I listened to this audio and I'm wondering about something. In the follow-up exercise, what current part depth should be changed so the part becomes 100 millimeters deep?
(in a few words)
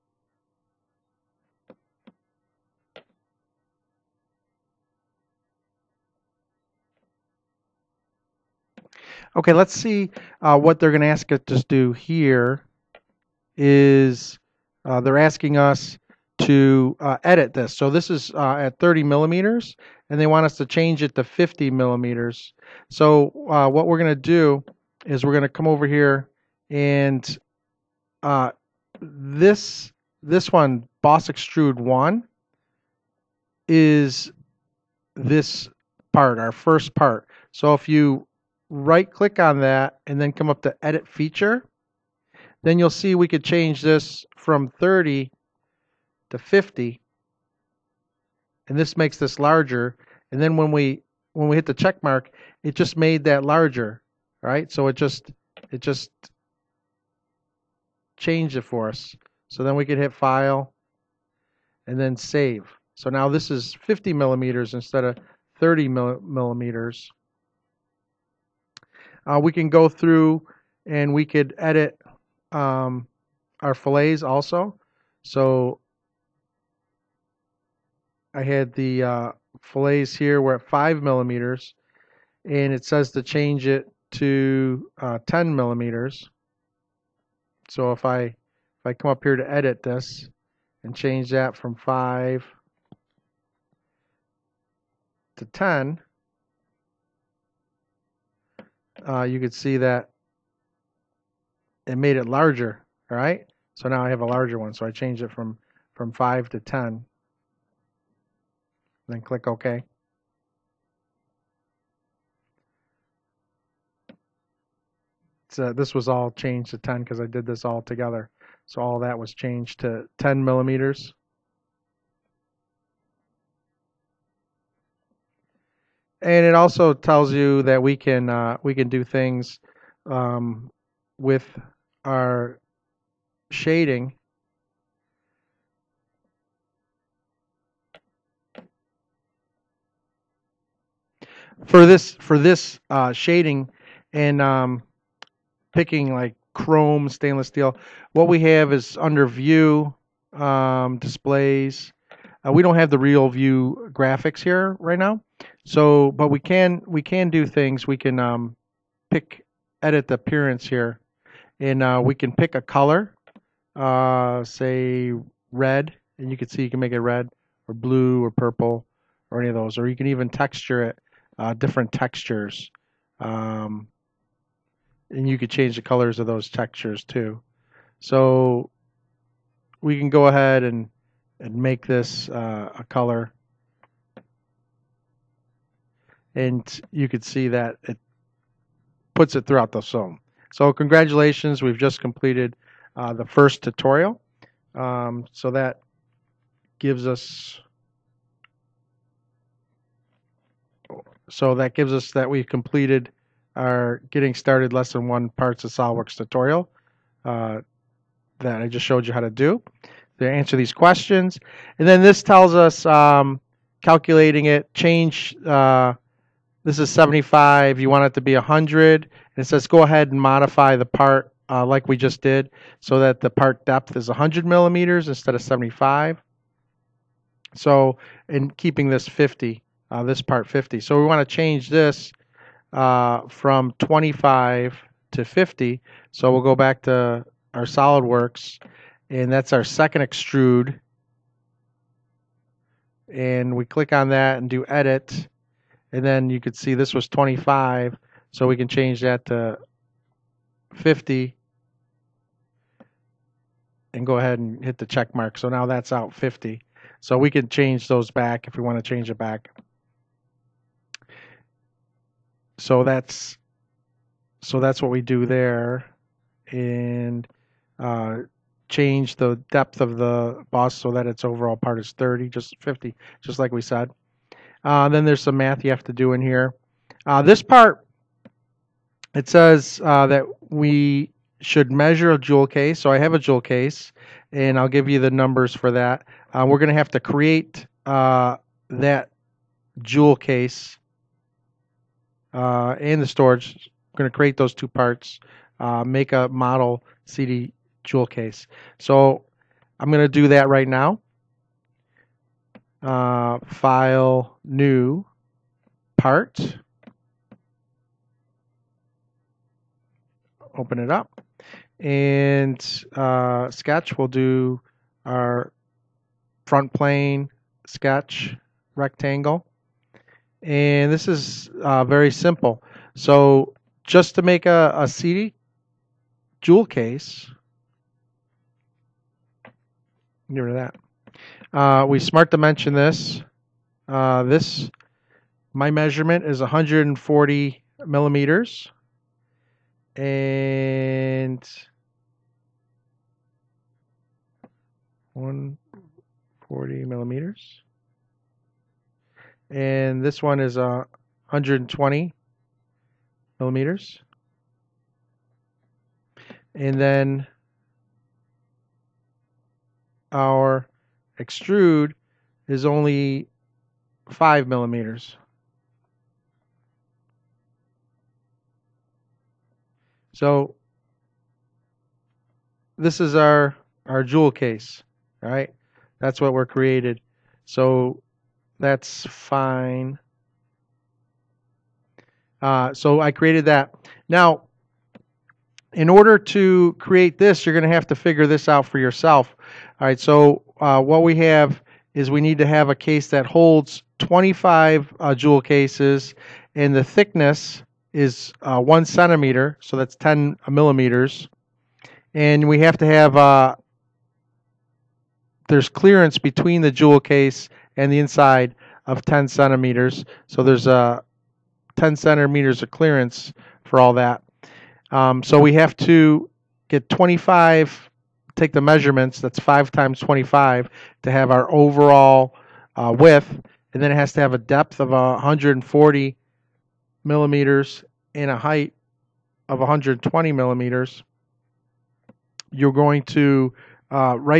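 75.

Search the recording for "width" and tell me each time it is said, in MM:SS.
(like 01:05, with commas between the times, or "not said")
07:02.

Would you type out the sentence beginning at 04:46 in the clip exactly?
Uh, we're going to have to create uh, that jewel case uh, and the storage.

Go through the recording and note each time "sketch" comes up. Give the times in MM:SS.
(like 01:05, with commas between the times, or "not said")
05:13, 05:17.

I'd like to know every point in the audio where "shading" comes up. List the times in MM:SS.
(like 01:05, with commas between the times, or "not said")
02:13, 02:23.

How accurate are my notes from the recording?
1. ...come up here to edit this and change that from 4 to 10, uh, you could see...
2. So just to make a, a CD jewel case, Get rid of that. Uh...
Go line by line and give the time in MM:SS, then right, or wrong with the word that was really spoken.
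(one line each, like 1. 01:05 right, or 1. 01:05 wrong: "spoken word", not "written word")
1. 01:28 wrong: "5", not "4"
2. 05:22 right.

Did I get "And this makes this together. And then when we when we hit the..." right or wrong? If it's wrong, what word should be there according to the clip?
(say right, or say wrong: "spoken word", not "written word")
wrong: "larger", not "together".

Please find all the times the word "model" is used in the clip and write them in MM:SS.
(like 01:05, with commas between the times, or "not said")
04:56.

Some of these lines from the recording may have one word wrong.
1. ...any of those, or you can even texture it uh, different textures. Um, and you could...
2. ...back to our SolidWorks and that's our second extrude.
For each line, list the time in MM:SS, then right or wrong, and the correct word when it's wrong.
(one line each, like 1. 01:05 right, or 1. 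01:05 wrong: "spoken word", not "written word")
1. 02:49 right
2. 03:56 right.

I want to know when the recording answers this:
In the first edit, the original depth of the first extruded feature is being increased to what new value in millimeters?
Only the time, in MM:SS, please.
00:20.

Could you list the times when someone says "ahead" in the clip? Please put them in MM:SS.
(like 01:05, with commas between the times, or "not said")
03:00, 03:39, 04:14.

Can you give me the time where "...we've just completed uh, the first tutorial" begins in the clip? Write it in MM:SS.
03:11.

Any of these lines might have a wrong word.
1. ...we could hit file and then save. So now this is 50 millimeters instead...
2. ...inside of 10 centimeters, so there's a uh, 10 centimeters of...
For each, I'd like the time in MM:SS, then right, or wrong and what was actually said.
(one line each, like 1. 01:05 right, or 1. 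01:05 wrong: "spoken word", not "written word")
1. 00:59 right
2. 06:47 right.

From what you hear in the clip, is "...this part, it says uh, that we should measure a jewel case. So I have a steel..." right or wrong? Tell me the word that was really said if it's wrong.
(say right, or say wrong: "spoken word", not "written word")
wrong: "jewel", not "steel".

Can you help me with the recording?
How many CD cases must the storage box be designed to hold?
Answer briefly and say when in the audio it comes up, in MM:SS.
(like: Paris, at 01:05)
25, at 06:33.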